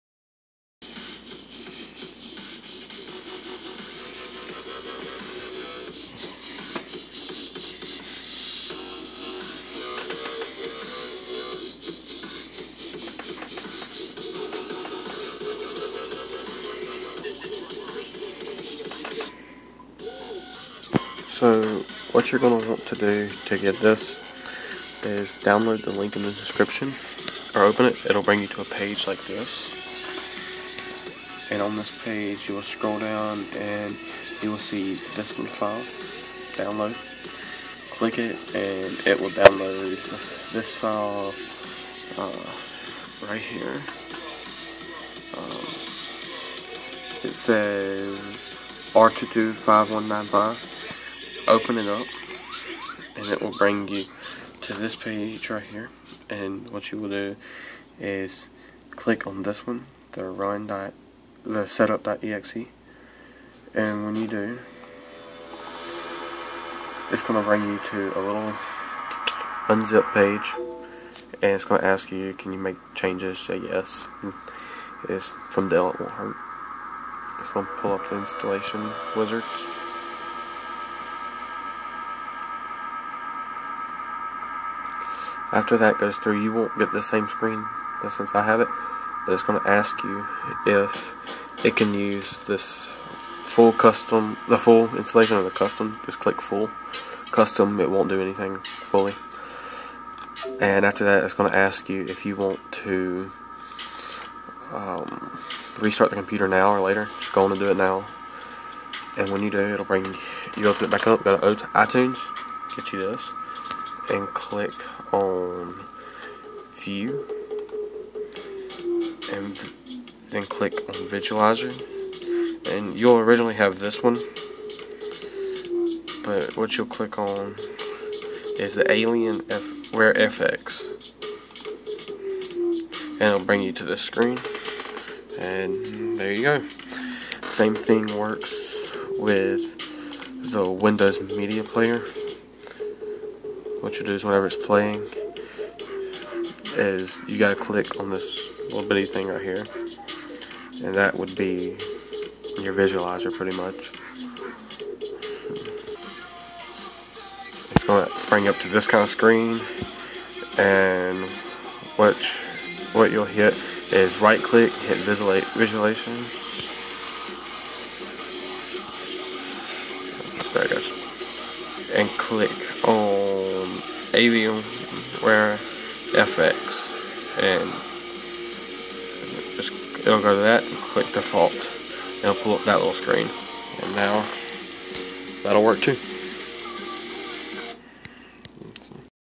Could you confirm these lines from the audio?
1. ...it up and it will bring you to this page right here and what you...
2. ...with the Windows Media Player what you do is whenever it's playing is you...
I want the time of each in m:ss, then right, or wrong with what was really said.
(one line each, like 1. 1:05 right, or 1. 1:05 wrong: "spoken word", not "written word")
1. 0:51 right
2. 2:19 right.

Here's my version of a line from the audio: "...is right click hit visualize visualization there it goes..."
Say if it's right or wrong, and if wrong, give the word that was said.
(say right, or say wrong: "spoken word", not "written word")
right.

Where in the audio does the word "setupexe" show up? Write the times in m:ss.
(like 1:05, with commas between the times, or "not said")
1:01.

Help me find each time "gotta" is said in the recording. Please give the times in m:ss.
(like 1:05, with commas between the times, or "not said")
2:27.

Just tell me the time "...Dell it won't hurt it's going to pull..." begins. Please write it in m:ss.
1:15.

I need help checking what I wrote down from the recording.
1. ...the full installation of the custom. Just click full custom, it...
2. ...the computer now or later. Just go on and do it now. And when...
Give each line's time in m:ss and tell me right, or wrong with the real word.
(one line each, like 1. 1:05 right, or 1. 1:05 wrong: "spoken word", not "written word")
1. 1:34 right
2. 1:46 right.